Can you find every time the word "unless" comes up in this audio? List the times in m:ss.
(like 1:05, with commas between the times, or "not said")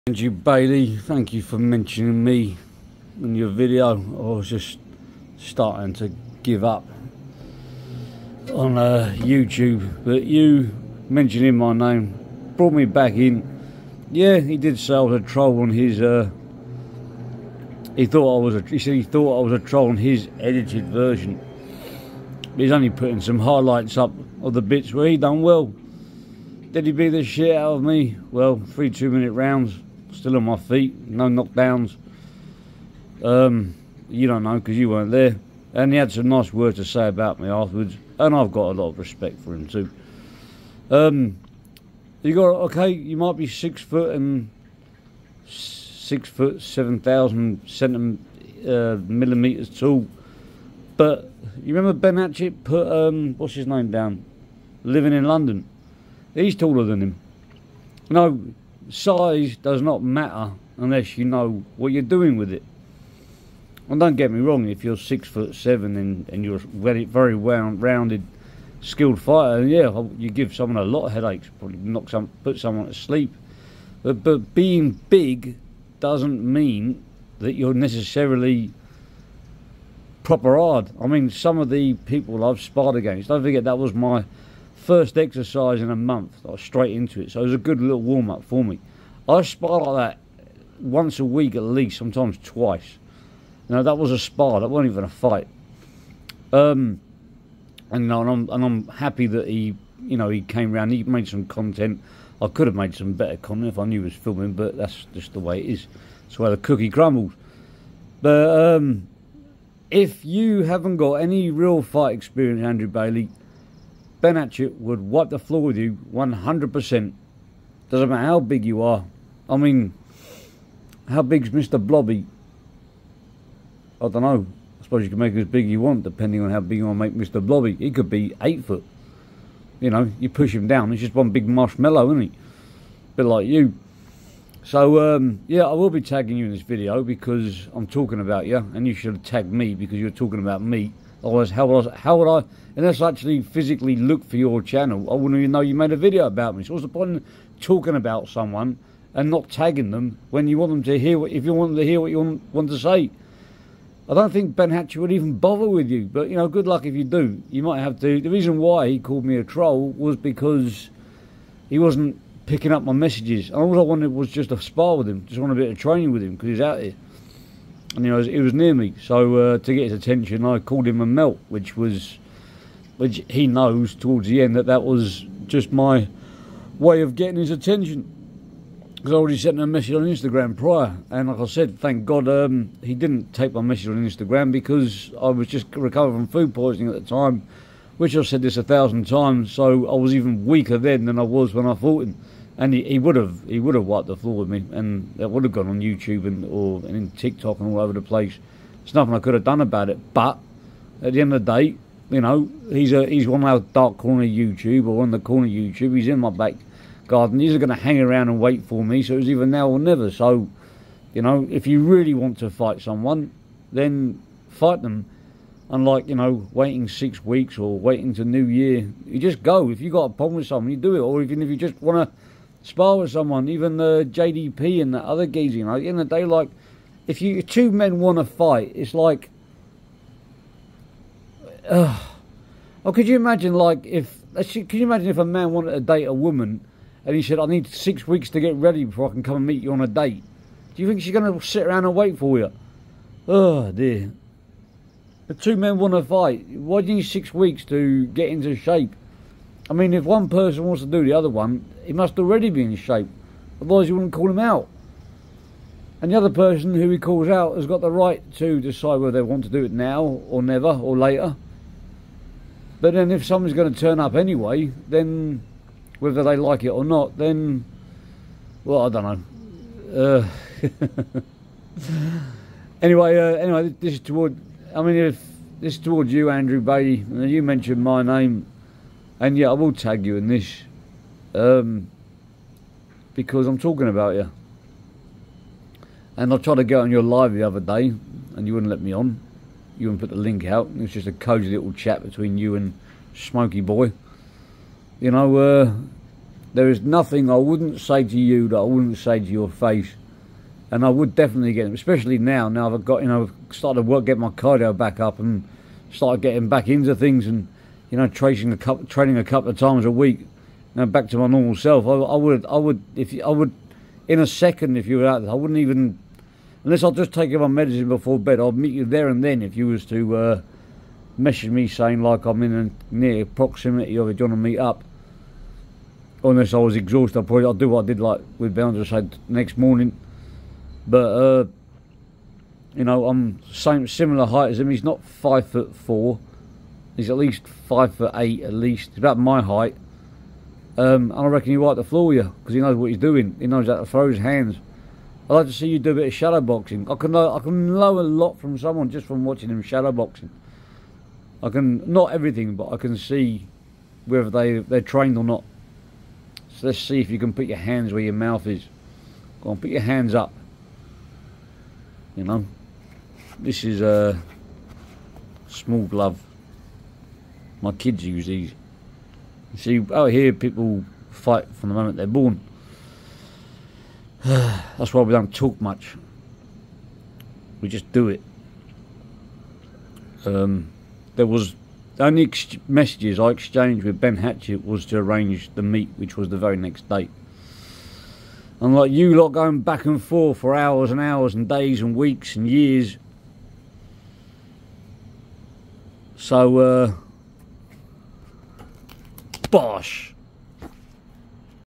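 1:00, 2:22, 5:16, 5:26.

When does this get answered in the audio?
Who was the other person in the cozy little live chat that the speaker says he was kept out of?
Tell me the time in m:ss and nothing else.
4:53.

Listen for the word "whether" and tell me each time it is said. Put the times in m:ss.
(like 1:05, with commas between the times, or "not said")
4:18, 4:26, 5:54.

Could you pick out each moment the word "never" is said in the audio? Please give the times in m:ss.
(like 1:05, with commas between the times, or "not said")
3:29, 4:20.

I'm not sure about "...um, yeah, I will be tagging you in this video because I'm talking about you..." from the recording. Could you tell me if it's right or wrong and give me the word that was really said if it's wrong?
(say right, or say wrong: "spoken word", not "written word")
right.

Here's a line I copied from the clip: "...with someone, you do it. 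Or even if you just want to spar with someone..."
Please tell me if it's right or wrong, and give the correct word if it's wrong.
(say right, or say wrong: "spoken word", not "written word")
right.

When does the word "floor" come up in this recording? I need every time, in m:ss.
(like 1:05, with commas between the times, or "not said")
1:55, 3:14, 5:41.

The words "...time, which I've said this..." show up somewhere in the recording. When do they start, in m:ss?
3:07.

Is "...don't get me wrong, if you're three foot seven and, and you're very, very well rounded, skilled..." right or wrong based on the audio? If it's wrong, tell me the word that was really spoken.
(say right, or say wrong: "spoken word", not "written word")
wrong: "six", not "three".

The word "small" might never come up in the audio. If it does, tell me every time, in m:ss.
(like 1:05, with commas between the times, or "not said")
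6:05.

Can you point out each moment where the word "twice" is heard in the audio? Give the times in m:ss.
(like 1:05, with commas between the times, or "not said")
1:32.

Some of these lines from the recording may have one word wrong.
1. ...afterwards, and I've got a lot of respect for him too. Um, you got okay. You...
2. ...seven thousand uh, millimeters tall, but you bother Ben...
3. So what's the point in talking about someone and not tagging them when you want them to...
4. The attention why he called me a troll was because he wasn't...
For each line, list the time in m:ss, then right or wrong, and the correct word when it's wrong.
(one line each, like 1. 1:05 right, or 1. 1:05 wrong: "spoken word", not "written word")
1. 0:37 right
2. 0:46 wrong: "remember", not "bother"
3. 2:26 right
4. 2:38 wrong: "reason", not "attention".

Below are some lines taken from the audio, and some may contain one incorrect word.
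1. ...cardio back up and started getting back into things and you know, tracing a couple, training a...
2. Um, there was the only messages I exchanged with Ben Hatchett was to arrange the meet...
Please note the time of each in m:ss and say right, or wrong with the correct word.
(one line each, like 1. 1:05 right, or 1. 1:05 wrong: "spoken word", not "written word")
1. 5:04 right
2. 6:20 right.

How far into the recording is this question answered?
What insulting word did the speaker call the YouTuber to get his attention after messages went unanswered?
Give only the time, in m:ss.
2:51.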